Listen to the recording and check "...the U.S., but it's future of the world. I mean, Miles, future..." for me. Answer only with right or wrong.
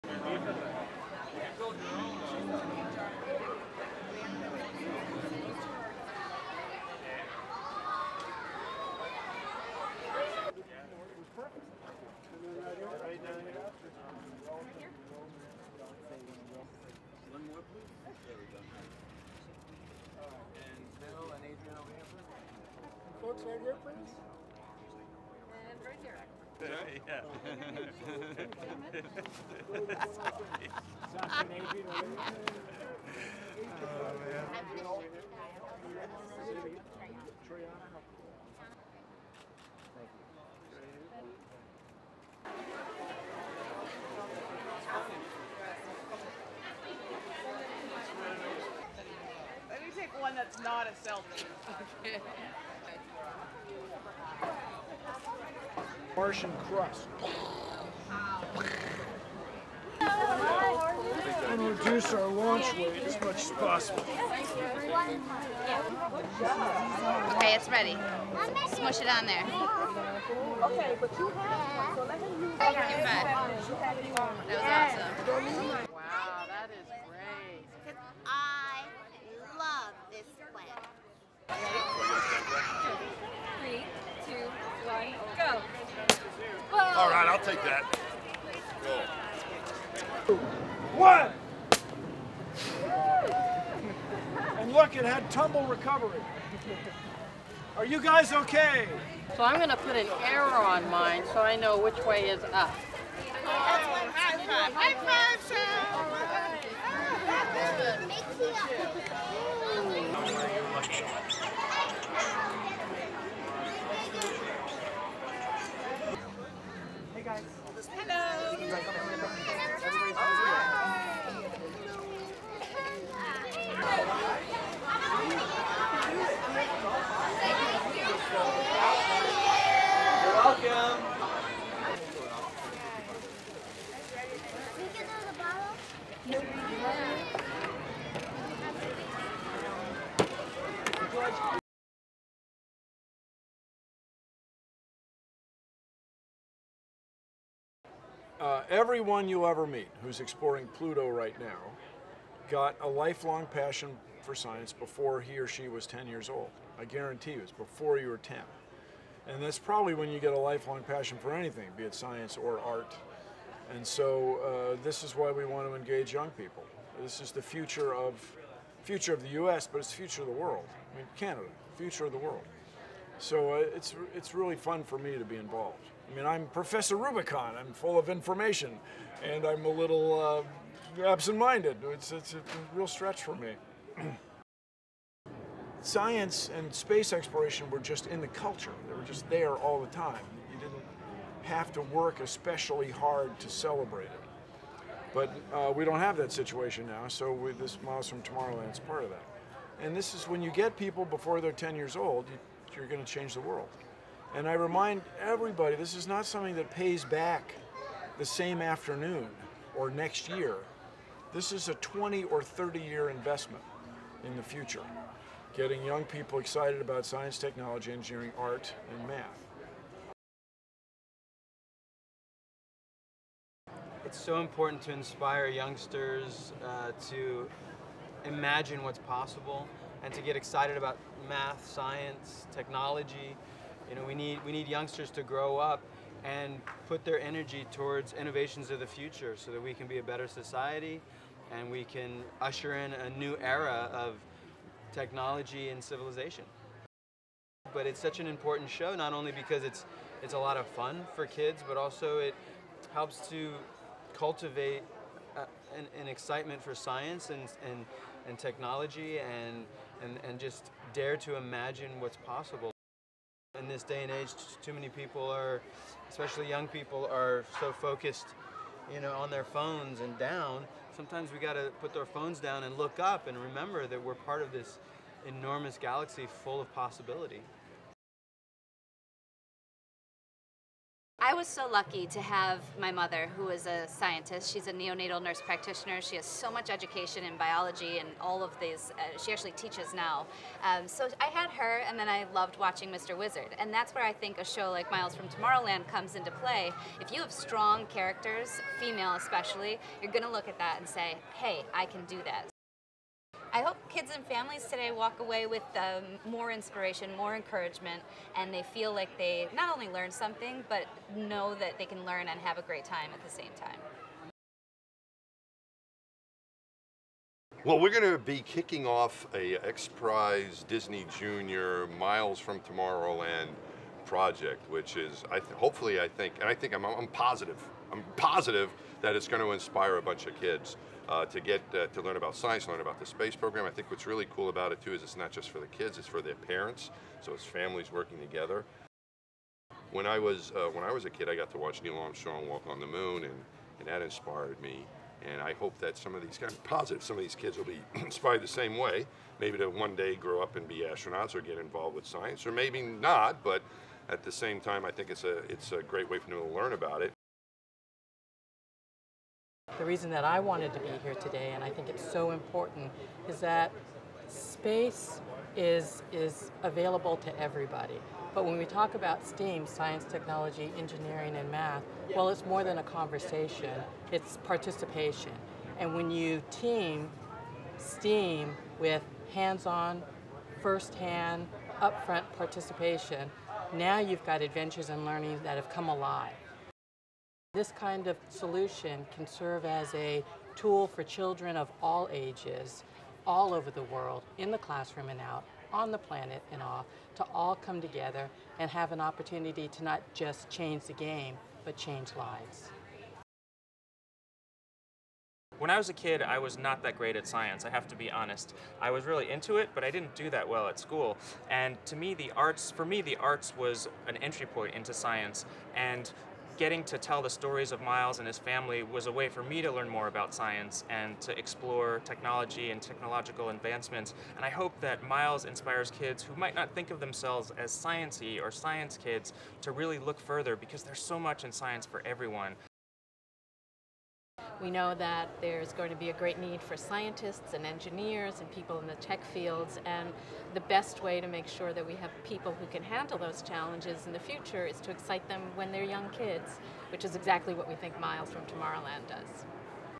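wrong.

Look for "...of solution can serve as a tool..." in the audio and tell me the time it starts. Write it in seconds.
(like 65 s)
388 s.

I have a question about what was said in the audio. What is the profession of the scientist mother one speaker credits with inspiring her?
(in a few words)
Neonatal nurse practitioner.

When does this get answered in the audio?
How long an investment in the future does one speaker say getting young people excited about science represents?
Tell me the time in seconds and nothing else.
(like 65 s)
211 s.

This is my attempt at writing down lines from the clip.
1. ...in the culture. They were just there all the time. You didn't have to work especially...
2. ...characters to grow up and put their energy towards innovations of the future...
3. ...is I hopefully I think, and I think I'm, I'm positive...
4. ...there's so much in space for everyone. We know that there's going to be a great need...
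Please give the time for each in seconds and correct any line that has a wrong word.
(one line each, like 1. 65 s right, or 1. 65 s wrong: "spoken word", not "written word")
1. 188 s right
2. 234 s wrong: "youngsters", not "characters"
3. 324 s right
4. 430 s wrong: "science", not "space".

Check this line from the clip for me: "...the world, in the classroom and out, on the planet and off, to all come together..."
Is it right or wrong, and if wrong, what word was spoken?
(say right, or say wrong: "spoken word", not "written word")
right.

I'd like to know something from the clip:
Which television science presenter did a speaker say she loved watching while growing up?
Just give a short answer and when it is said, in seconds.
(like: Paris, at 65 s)
Mr. Wizard, at 292 s.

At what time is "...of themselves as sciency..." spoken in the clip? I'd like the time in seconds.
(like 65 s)
426 s.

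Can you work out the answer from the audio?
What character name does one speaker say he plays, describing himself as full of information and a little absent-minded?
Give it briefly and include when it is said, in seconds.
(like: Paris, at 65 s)
Professor Rubicon, at 176 s.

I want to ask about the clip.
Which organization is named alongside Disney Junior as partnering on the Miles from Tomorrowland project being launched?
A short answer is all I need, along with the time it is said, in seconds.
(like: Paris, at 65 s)
XPRIZE, at 319 s.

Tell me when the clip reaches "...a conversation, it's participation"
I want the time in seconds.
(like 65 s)
372 s.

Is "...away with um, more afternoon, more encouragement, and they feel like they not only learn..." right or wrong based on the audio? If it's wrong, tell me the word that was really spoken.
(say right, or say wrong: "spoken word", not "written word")
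wrong: "inspiration", not "afternoon".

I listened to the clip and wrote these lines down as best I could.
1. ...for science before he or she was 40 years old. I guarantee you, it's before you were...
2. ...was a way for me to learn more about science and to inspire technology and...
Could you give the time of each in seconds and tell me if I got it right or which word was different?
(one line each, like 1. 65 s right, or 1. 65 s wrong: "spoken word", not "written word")
1. 154 s wrong: "10", not "40"
2. 418 s wrong: "explore", not "inspire".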